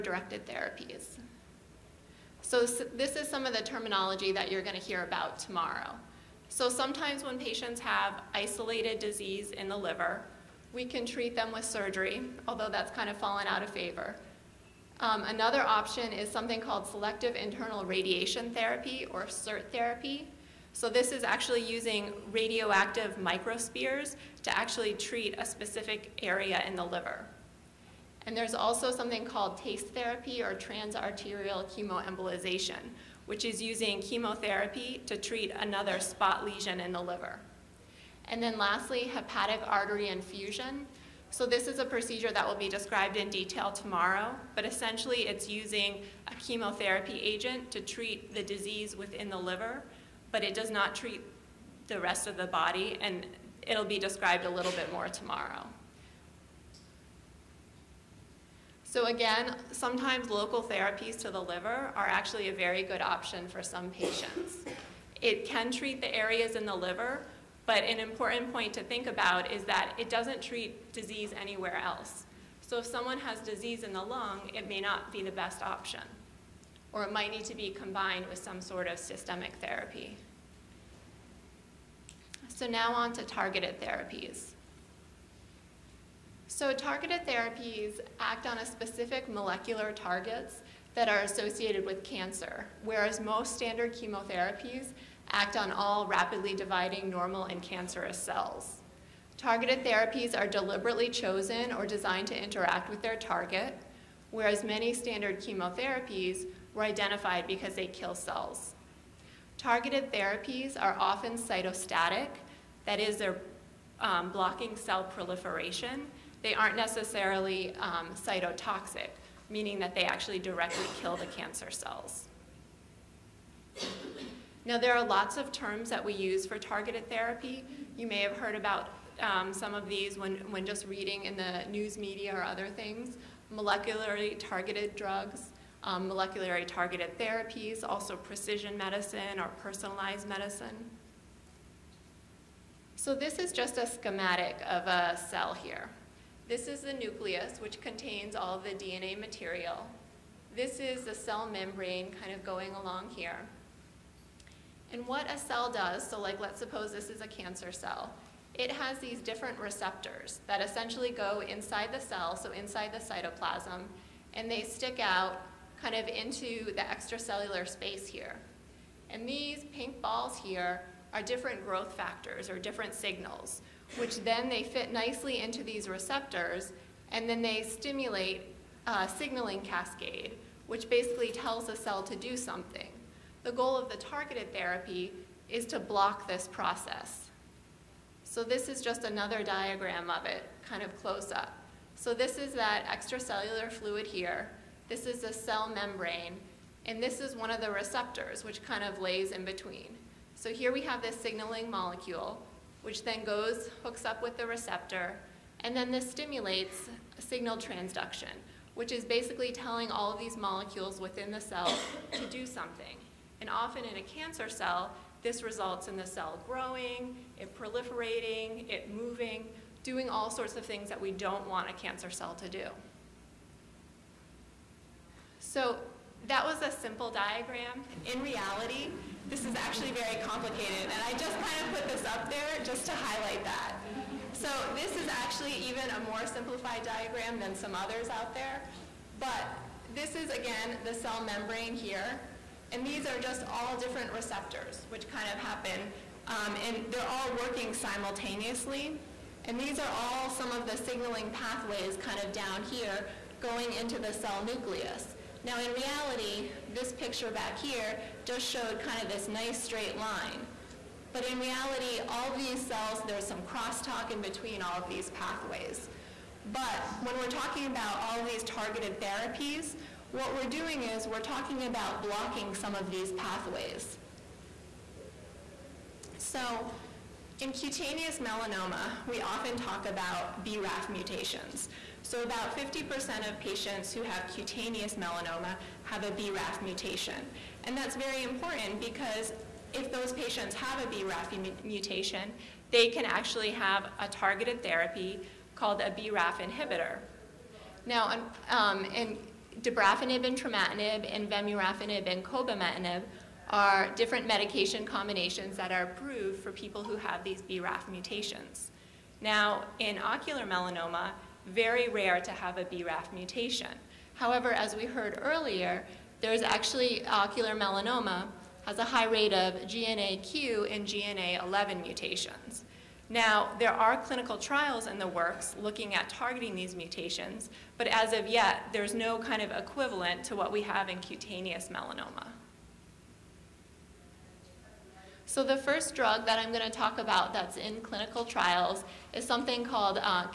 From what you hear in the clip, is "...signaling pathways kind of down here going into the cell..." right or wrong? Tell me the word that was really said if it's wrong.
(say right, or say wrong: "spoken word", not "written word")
right.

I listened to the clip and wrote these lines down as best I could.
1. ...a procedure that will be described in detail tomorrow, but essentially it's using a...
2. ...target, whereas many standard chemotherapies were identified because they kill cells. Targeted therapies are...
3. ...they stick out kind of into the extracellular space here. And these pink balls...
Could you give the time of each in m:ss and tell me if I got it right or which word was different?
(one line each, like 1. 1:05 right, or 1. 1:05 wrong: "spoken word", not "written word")
1. 0:41 right
2. 1:43 right
3. 2:44 right.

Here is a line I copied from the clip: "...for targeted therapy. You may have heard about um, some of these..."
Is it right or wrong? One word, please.
right.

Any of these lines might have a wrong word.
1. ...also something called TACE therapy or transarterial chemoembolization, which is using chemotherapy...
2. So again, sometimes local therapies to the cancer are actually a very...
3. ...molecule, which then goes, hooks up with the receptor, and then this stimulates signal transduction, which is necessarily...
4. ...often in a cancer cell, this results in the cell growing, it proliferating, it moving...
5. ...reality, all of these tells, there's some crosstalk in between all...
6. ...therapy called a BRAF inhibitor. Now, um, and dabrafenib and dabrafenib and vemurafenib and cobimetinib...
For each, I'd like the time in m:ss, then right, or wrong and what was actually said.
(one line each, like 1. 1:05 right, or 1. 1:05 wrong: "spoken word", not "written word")
1. 0:28 right
2. 0:58 wrong: "liver", not "cancer"
3. 3:21 wrong: "basically", not "necessarily"
4. 3:33 right
5. 4:21 wrong: "cells", not "tells"
6. 4:54 wrong: "trametinib", not "dabrafenib".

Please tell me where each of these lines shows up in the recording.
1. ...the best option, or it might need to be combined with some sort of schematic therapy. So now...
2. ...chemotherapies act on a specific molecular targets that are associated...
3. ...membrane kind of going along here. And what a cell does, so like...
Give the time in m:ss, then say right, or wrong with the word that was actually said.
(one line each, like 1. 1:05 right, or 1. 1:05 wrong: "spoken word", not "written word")
1. 1:15 wrong: "systemic", not "schematic"
2. 1:27 wrong: "therapies", not "chemotherapies"
3. 2:31 right.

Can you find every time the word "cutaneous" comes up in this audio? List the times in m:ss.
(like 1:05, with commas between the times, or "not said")
4:37, 4:44, 5:30.